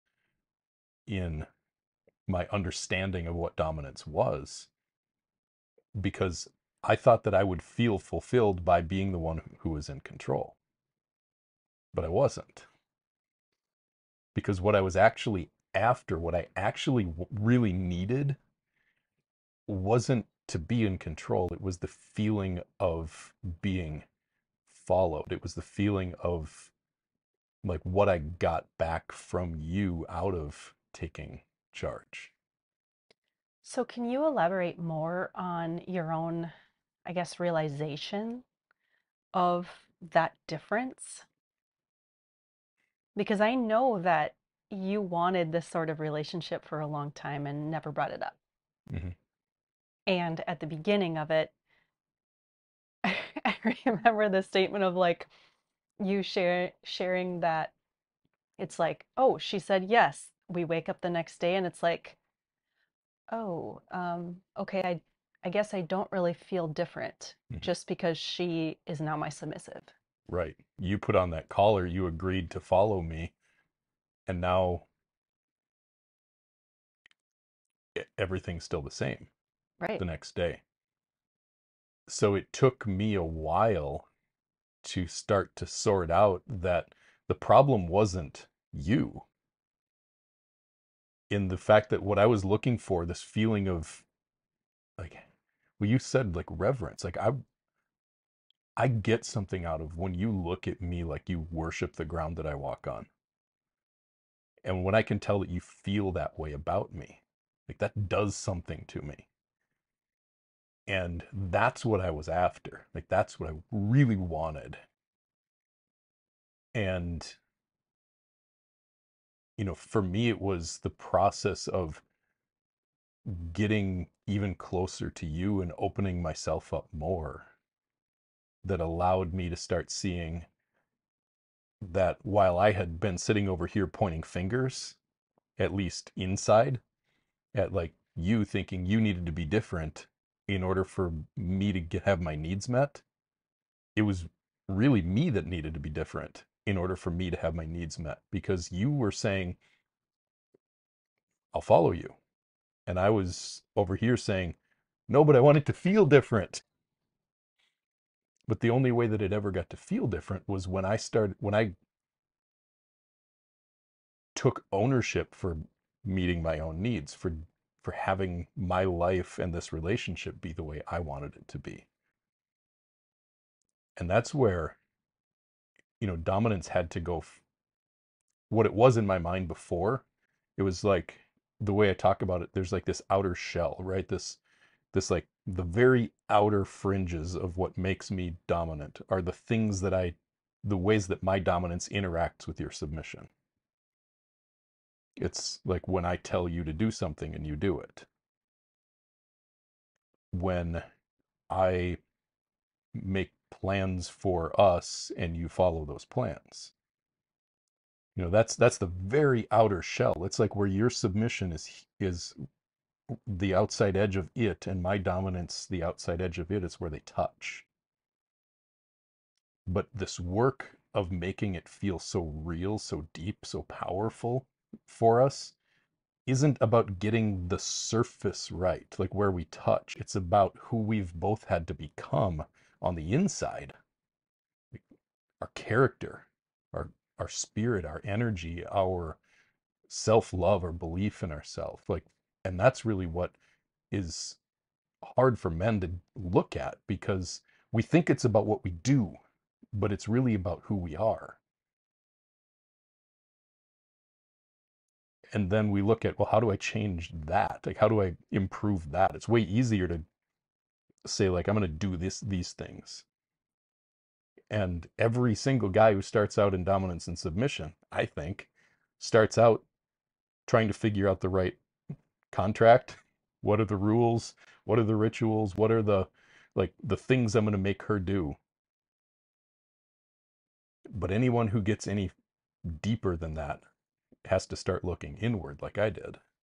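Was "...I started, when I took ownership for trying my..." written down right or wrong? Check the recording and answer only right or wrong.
wrong.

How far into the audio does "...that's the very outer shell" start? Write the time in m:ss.
3:28.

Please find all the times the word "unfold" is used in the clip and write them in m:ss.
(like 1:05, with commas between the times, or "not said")
not said.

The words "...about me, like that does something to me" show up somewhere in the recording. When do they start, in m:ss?
1:46.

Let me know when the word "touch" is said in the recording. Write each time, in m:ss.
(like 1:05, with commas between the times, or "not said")
3:37, 3:49.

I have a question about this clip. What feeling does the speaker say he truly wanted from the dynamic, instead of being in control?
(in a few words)
Being followed.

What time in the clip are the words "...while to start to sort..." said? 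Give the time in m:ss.
1:23.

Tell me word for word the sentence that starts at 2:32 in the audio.
And I was over here saying, no, but I want it to feel different.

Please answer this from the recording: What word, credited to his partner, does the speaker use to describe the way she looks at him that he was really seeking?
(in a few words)
Reverence.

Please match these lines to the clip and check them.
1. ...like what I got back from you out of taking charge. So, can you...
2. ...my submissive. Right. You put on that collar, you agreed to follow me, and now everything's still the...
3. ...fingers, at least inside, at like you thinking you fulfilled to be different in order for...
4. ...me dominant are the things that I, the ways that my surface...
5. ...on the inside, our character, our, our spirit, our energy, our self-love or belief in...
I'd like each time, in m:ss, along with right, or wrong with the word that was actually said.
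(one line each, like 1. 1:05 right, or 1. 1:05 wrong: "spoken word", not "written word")
1. 0:27 right
2. 1:09 right
3. 2:14 wrong: "needed", not "fulfilled"
4. 3:08 wrong: "dominance", not "surface"
5. 3:52 right.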